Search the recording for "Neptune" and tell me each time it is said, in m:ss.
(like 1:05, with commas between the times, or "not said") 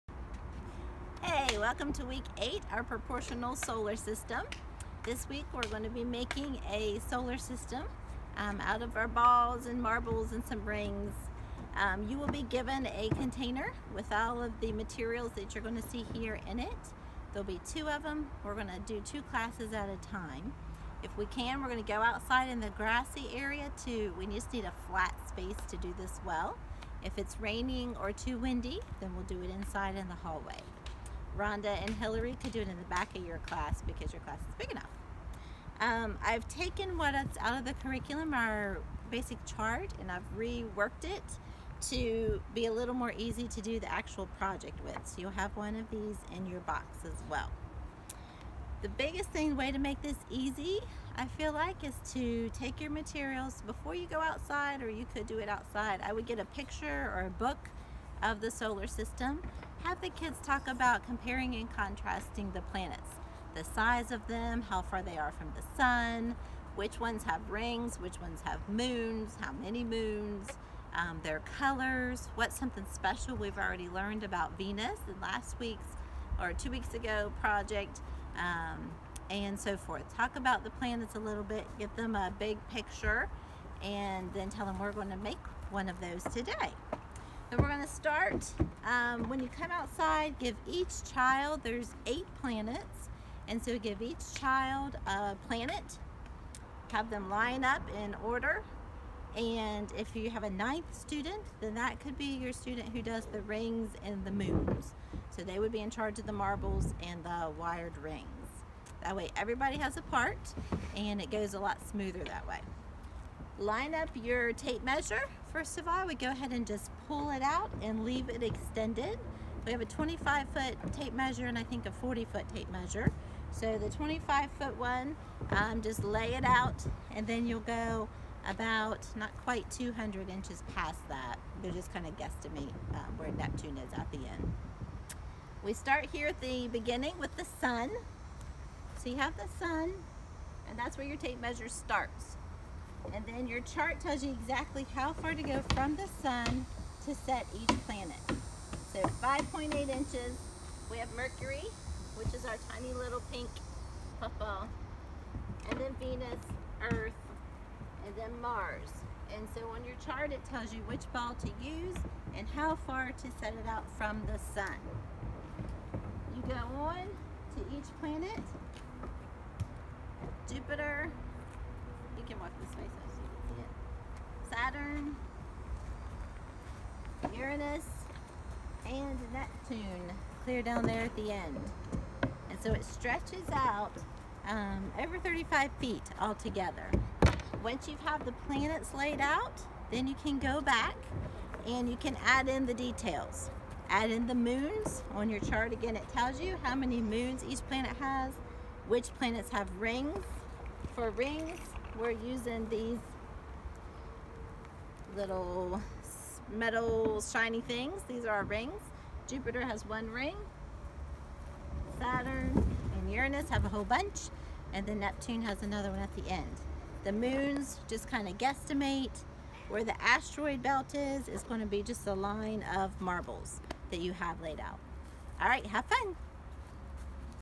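2:13, 2:59, 3:34.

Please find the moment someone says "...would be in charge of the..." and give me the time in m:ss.
1:45.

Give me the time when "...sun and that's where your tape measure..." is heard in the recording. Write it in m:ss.
2:19.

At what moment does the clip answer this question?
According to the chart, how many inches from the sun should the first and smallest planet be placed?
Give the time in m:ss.
2:29.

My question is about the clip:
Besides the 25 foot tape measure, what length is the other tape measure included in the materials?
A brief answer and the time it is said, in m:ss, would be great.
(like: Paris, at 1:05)
40 foot, at 2:01.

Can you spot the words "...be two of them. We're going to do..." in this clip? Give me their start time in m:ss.
0:17.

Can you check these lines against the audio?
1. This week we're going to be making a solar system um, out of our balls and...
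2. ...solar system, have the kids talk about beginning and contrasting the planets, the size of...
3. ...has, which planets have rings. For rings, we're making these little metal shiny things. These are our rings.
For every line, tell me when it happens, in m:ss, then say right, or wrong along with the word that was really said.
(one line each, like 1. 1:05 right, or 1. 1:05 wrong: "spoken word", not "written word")
1. 0:05 right
2. 0:58 wrong: "comparing", not "beginning"
3. 3:17 wrong: "using", not "making".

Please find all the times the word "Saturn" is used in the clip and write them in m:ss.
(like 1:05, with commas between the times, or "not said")
2:54, 3:31.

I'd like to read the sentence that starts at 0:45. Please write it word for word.
So you'll have one of these in your box as well.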